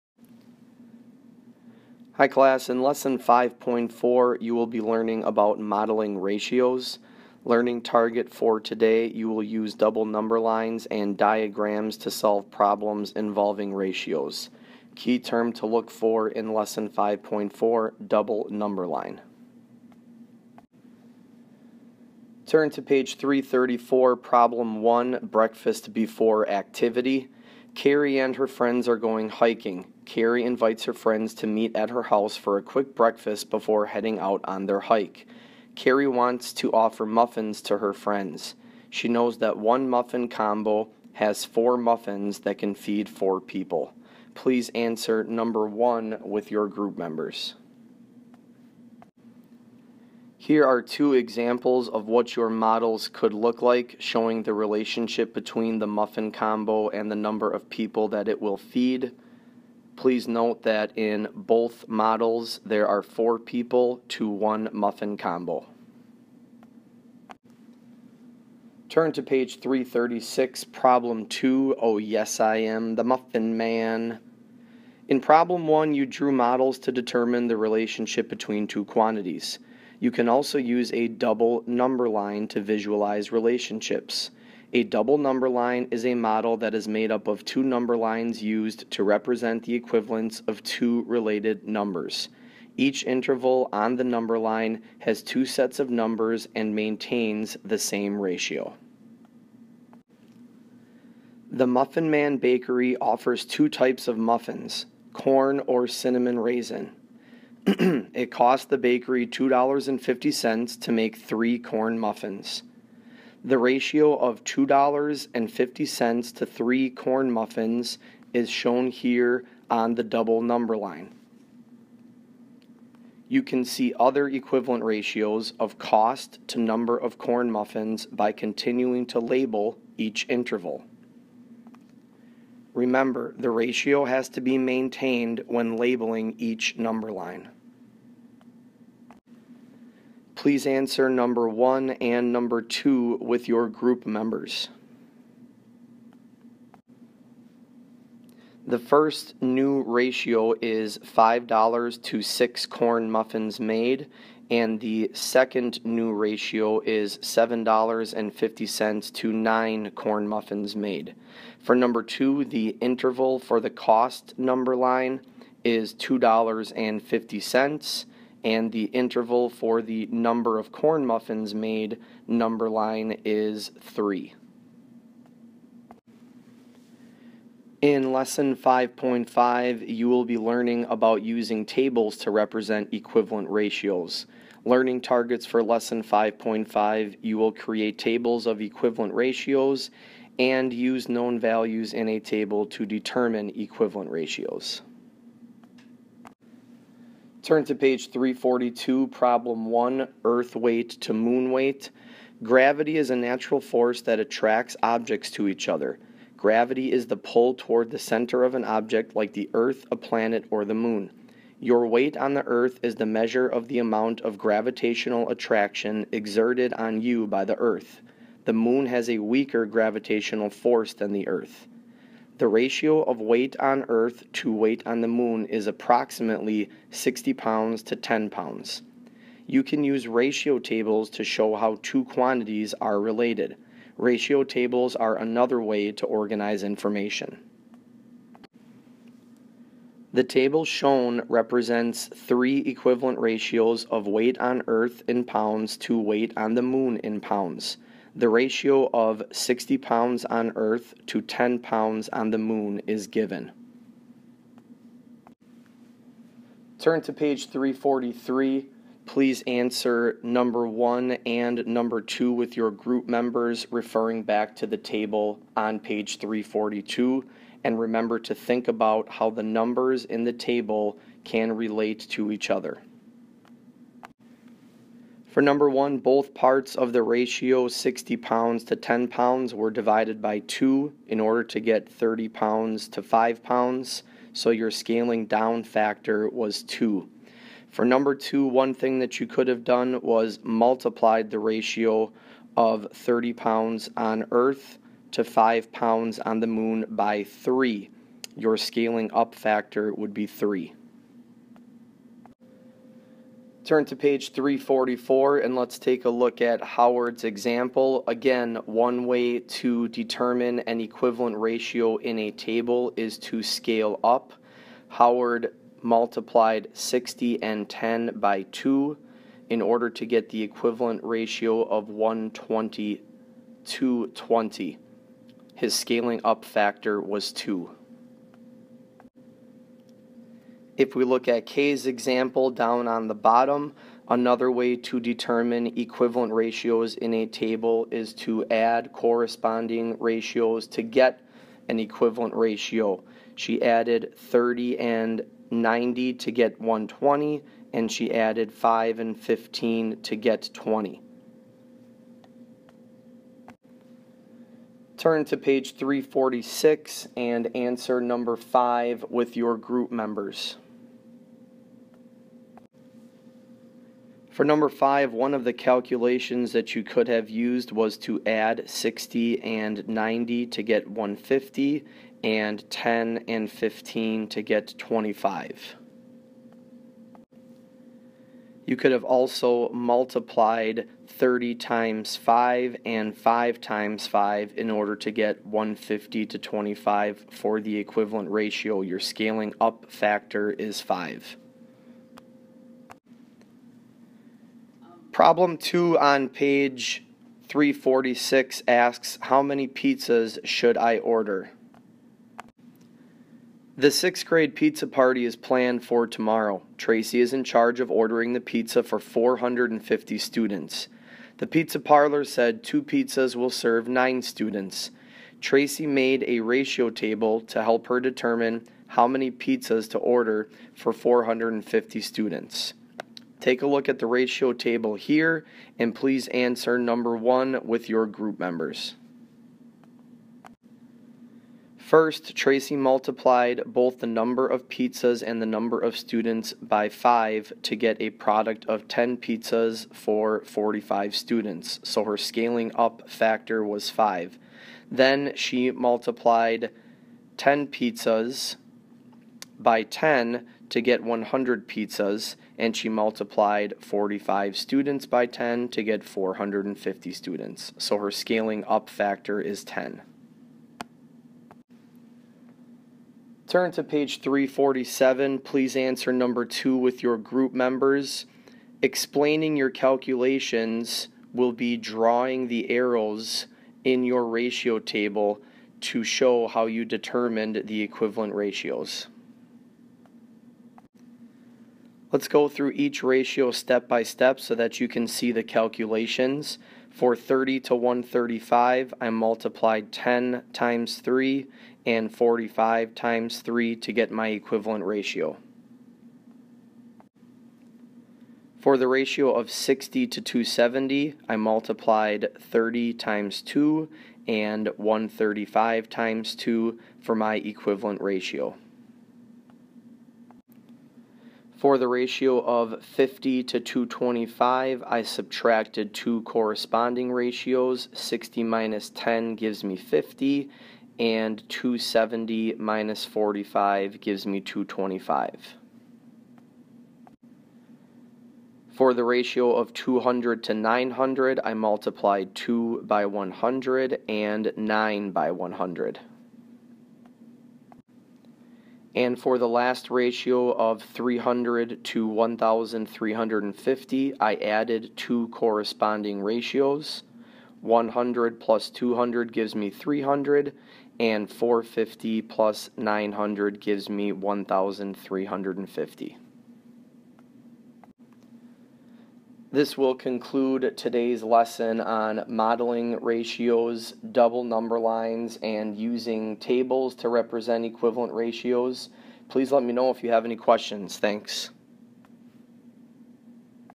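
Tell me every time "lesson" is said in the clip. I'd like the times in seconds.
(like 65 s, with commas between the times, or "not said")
2 s, 16 s, 178 s, 185 s, 561 s.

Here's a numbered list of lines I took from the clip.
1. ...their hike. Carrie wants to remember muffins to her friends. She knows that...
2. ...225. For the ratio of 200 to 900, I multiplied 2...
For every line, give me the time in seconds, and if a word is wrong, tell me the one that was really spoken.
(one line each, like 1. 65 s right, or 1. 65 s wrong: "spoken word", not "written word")
1. 34 s wrong: "offer", not "remember"
2. 524 s right.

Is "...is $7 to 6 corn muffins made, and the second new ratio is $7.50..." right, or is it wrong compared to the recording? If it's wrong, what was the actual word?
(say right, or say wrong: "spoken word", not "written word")
wrong: "5", not "7".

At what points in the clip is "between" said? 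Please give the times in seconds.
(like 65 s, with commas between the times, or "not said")
55 s, 78 s.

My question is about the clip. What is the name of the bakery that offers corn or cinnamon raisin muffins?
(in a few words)
Muffin Man Bakery.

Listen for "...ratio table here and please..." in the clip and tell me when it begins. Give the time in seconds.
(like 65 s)
424 s.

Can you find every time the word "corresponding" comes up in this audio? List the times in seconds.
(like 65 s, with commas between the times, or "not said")
338 s, 516 s.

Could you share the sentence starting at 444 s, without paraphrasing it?
Then she multiplied 10 pizzas by 10 to get 100 pizzas, and she multiplied 45 students by 10 to get 450 students.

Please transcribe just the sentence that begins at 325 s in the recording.
His scaling up factor was 2.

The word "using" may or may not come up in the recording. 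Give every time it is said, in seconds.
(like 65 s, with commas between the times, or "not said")
181 s, 565 s.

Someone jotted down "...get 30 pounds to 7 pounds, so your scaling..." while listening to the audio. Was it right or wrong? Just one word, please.
wrong.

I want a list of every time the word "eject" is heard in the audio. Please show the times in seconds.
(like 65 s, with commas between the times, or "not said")
not said.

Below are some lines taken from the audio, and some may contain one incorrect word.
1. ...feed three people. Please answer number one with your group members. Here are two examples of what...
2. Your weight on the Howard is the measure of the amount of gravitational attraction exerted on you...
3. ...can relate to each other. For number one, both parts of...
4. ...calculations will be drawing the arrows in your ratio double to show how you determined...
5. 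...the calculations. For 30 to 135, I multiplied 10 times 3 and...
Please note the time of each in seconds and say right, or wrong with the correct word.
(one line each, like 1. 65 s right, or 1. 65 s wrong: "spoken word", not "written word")
1. 42 s wrong: "four", not "three"
2. 211 s wrong: "Earth", not "Howard"
3. 271 s right
4. 469 s wrong: "table", not "double"
5. 485 s right.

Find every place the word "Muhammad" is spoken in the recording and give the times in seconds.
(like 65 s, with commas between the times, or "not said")
not said.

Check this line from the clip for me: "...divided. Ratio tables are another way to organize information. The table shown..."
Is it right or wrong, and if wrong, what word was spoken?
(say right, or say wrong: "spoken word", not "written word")
wrong: "related", not "divided".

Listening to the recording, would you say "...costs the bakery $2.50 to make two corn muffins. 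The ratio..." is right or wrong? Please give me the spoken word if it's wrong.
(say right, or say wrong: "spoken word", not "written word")
wrong: "three", not "two".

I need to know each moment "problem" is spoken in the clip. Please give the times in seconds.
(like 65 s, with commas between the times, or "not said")
12 s, 24 s, 70 s, 75 s, 199 s, 395 s.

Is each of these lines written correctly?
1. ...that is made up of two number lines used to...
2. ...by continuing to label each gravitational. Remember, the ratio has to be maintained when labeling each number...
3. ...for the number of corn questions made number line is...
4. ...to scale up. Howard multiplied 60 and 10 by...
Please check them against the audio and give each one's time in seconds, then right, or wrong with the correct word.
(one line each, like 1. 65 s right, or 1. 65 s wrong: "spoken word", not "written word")
1. 86 s right
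2. 128 s wrong: "interval", not "gravitational"
3. 169 s wrong: "muffins", not "questions"
4. 313 s right.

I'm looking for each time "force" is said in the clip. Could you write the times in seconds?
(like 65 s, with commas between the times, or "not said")
203 s, 220 s.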